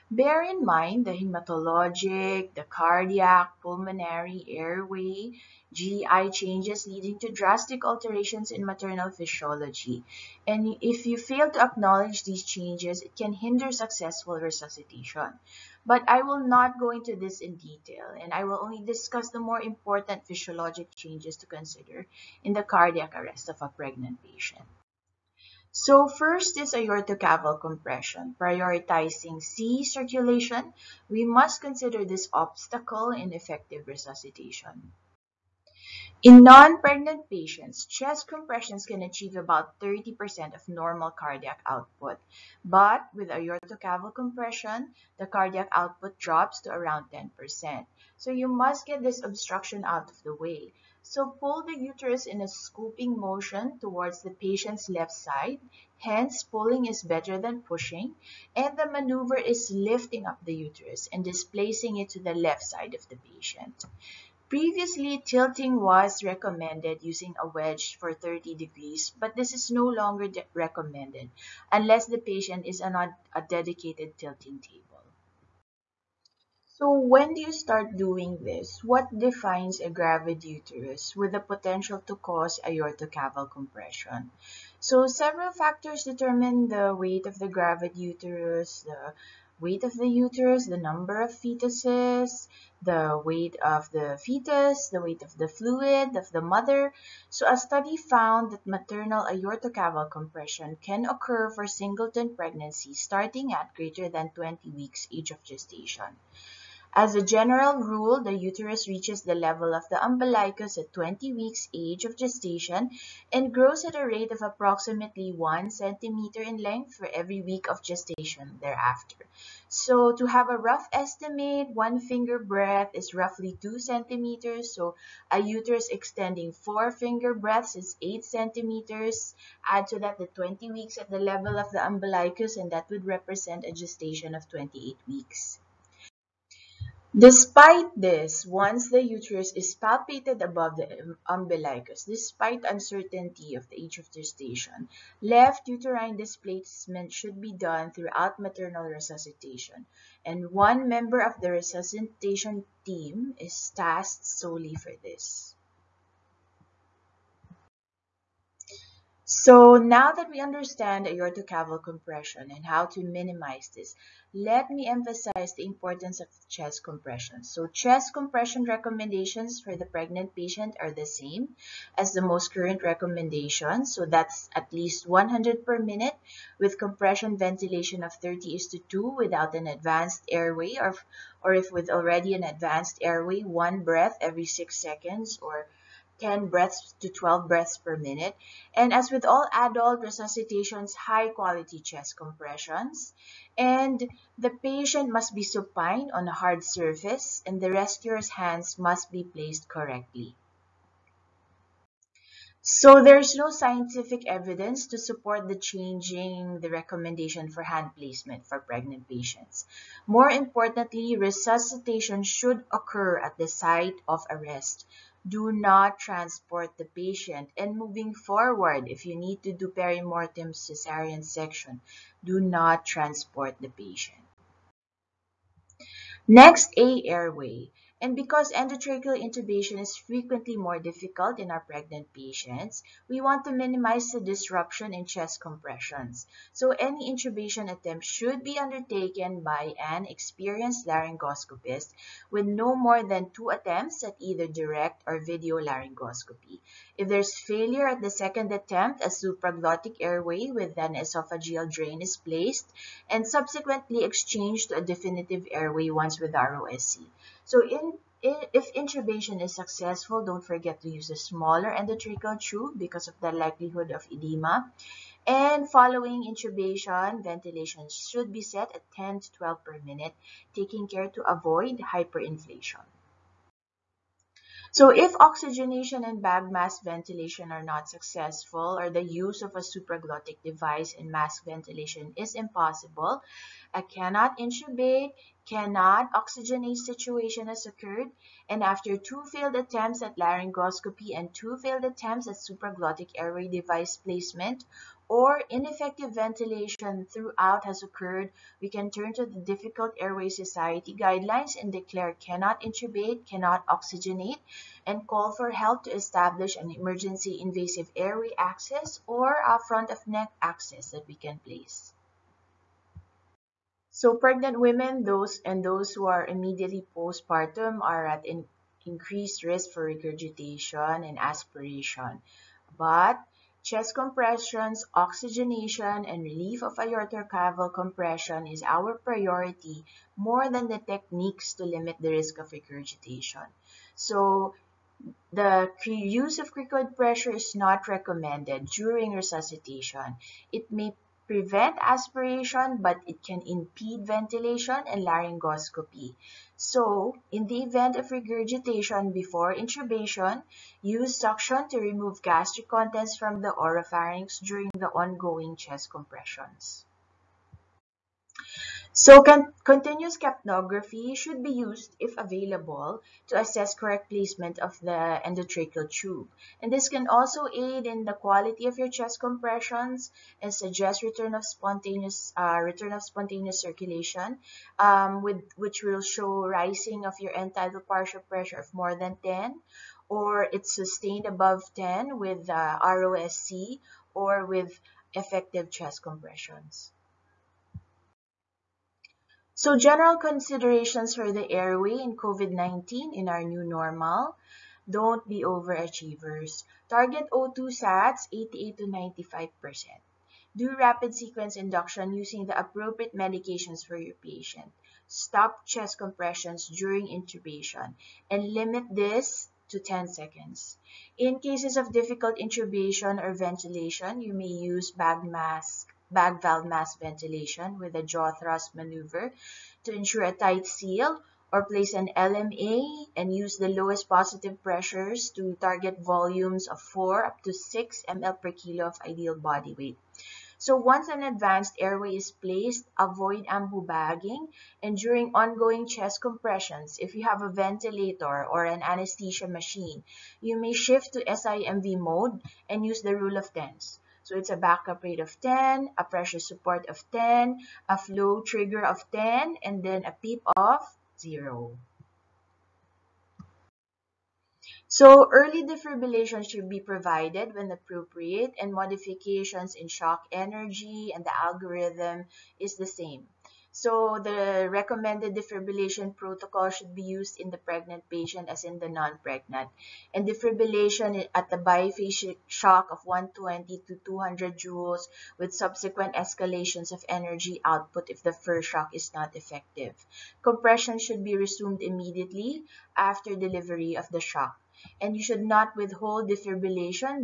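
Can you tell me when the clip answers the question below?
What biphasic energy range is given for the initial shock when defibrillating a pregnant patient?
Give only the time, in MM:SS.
07:53.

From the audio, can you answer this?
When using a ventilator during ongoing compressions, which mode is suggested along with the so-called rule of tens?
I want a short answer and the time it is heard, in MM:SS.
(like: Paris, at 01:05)
SIMV, at 07:21.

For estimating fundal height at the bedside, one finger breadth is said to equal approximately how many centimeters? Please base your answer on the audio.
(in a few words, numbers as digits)
2 centimeters.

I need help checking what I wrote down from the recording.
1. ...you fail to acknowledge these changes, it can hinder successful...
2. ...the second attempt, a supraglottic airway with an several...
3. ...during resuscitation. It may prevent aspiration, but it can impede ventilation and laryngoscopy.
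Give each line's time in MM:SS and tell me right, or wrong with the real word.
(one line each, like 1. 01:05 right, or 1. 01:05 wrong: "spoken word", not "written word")
1. 00:11 right
2. 04:07 wrong: "esophageal", not "several"
3. 05:38 right.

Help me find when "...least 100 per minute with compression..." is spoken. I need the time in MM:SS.
02:54.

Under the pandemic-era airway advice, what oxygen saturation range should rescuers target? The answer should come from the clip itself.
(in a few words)
88 to 95%.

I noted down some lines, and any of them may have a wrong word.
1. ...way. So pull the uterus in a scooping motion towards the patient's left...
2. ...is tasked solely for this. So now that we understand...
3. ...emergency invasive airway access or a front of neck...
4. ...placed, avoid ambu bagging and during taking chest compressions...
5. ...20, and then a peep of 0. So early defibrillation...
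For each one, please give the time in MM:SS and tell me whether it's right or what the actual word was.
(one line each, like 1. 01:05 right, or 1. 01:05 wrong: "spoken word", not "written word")
1. 00:50 right
2. 02:33 right
3. 05:06 right
4. 07:12 wrong: "ongoing", not "taking"
5. 07:29 wrong: "10", not "20".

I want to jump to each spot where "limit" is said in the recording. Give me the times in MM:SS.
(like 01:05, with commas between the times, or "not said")
05:31, 06:48.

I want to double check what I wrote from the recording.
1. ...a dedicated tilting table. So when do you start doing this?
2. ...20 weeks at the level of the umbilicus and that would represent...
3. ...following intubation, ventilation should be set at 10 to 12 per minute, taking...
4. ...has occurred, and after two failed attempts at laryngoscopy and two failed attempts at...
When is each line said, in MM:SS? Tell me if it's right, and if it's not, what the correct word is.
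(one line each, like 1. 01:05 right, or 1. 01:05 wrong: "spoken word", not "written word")
1. 01:12 right
2. 02:10 right
3. 04:25 right
4. 04:47 right.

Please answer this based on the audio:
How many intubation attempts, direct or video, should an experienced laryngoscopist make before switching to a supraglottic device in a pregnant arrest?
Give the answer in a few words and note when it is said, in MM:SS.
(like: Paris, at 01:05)
2, at 04:03.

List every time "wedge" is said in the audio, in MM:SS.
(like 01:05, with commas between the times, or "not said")
01:07.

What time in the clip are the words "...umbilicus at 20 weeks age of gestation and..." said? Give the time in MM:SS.
01:50.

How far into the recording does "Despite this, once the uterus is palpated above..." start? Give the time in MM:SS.
02:17.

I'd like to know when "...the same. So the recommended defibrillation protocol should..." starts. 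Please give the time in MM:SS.
07:42.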